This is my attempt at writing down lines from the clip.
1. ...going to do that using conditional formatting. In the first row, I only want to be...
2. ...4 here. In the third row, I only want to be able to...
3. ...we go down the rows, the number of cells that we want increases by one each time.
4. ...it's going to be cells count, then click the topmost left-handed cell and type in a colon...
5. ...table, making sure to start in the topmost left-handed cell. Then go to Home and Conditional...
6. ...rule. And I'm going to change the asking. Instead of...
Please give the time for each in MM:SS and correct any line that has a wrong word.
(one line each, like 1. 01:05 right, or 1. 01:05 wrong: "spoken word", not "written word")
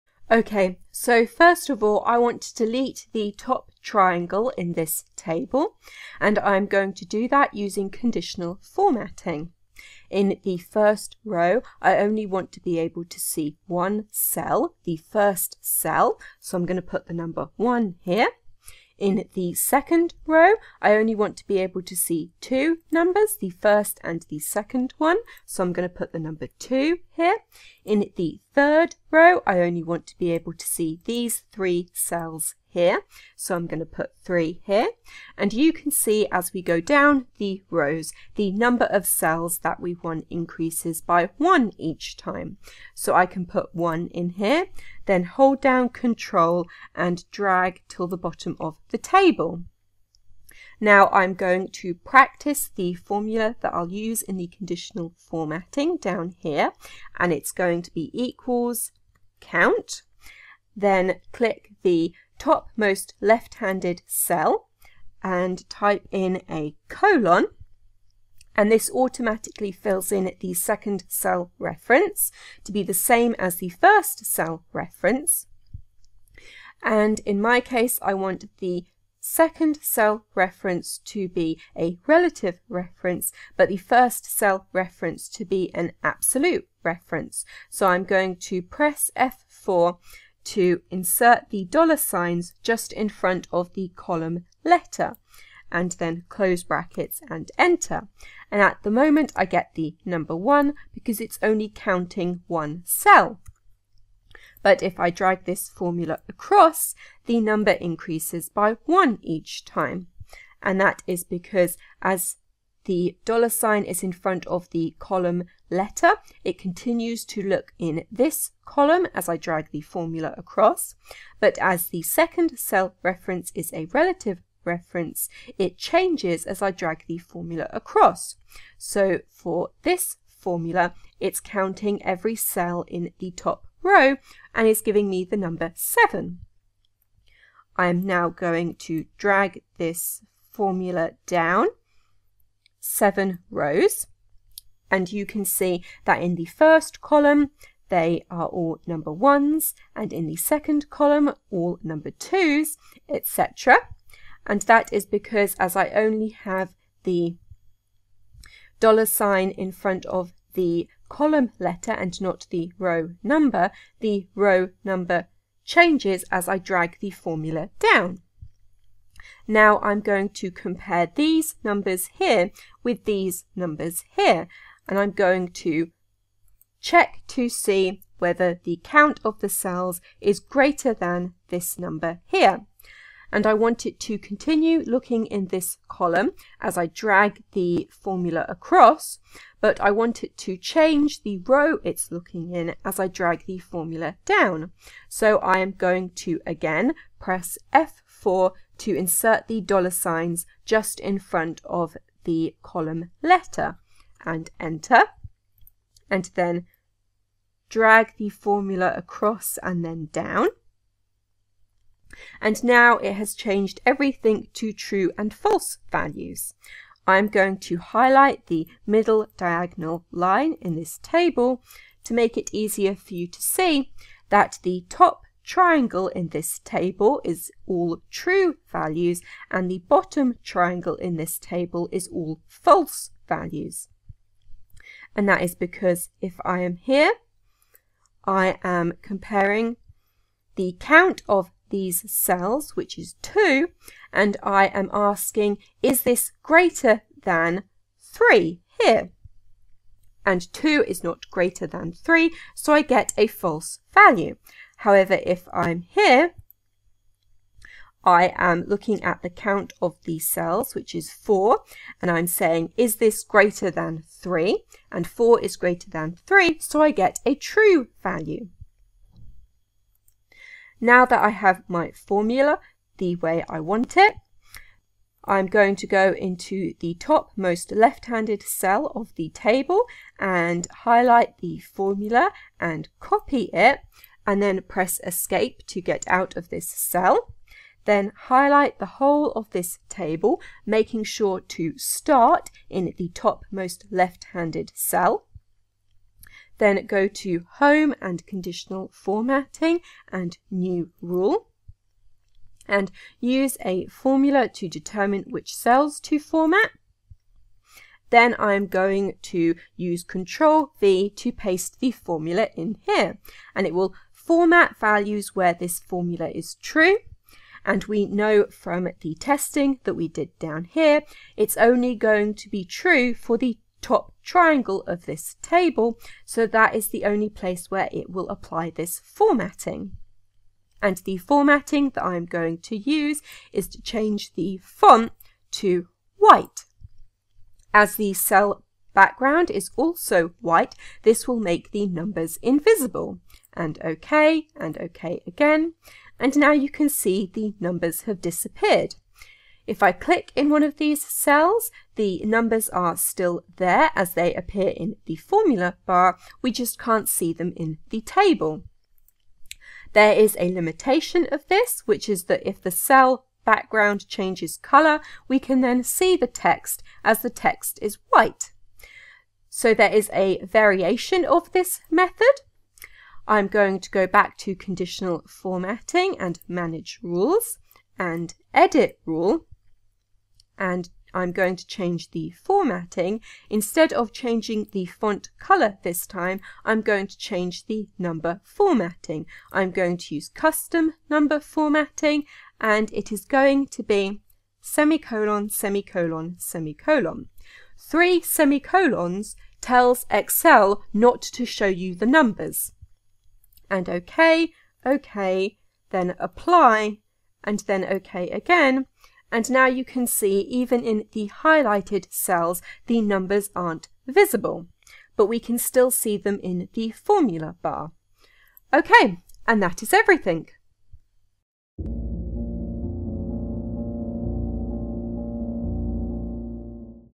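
1. 00:06 right
2. 00:26 wrong: "2", not "4"
3. 00:36 right
4. 00:57 wrong: "equals", not "cells"
5. 04:49 right
6. 06:19 wrong: "formatting", not "asking".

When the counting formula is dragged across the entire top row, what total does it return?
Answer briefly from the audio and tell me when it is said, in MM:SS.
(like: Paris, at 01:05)
7, at 02:15.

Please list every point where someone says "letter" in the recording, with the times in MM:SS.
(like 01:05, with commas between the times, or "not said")
01:34, 01:55, 02:41, 03:23.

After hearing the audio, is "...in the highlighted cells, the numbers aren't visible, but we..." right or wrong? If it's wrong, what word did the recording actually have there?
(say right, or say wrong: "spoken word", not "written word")
right.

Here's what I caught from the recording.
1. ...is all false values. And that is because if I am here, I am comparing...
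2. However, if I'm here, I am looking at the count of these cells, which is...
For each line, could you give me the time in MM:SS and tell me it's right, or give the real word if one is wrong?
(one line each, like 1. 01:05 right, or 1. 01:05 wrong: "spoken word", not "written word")
1. 03:51 right
2. 04:14 right.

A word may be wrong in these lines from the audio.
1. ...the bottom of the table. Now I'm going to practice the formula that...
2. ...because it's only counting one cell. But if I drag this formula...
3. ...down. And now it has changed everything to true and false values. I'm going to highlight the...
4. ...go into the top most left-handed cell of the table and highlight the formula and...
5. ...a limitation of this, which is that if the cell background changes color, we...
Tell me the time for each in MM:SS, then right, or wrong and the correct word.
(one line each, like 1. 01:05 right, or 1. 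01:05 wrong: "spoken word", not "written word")
1. 00:48 right
2. 01:40 right
3. 03:30 right
4. 04:35 right
5. 06:00 right.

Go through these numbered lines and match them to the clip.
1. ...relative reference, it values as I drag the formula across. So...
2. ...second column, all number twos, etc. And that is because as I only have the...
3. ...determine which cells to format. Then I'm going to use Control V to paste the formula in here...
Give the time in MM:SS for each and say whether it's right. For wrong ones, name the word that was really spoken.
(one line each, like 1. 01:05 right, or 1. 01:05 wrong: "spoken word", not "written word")
1. 02:03 wrong: "changes", not "values"
2. 02:30 right
3. 05:04 right.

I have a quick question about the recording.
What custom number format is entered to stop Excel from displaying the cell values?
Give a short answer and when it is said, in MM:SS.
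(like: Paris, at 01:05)
Three semicolons, at 06:34.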